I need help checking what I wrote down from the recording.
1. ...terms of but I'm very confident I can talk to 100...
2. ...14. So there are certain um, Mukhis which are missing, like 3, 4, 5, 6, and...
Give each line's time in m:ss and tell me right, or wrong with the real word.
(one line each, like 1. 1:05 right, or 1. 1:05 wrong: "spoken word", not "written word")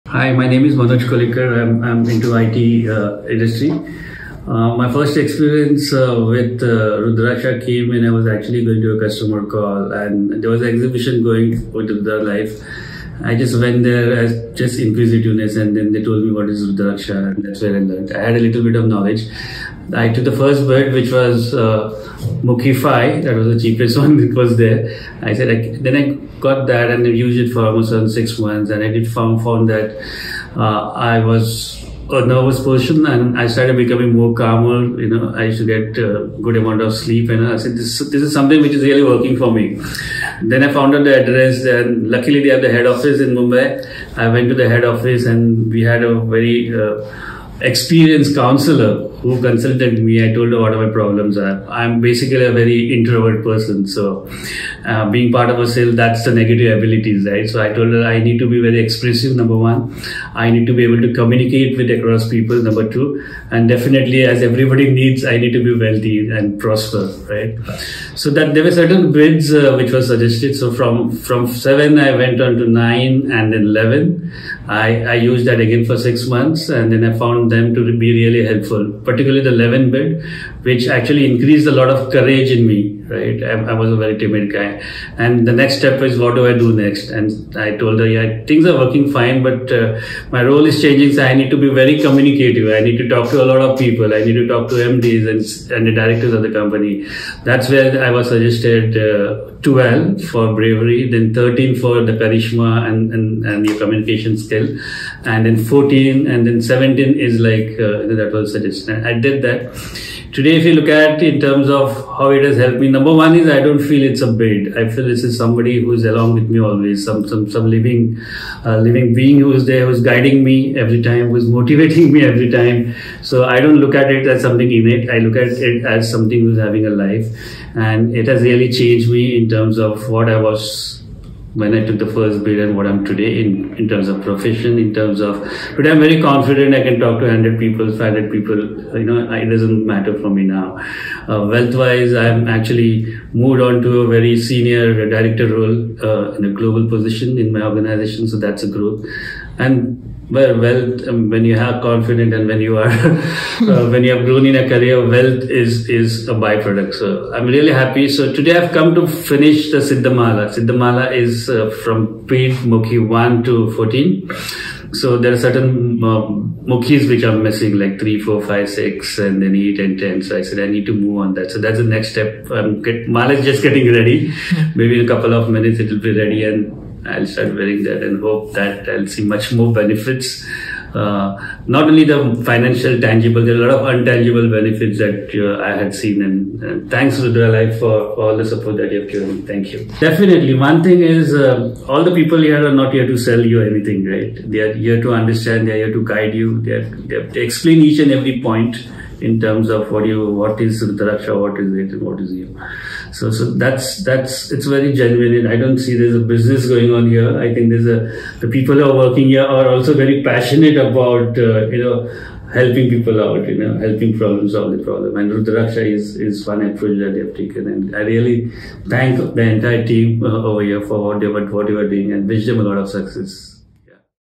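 1. 2:14 right
2. 2:43 right.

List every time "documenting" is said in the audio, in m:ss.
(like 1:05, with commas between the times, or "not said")
not said.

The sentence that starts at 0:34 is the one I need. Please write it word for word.
You know, I used to get a uh, good amount of sleep.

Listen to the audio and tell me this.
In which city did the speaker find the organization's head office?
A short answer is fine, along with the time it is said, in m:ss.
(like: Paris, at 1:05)
Mumbai, at 0:43.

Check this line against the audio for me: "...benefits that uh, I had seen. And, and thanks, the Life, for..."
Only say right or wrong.
right.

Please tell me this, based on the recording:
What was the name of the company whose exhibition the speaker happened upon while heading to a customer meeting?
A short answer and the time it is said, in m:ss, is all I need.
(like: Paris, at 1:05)
Rudralife, at 0:11.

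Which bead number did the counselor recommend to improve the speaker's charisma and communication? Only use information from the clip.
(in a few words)
13.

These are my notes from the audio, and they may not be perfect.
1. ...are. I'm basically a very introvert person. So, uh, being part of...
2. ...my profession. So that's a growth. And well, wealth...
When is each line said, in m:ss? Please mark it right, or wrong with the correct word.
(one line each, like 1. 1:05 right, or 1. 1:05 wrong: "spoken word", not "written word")
1. 0:51 right
2. 2:27 wrong: "organization", not "profession".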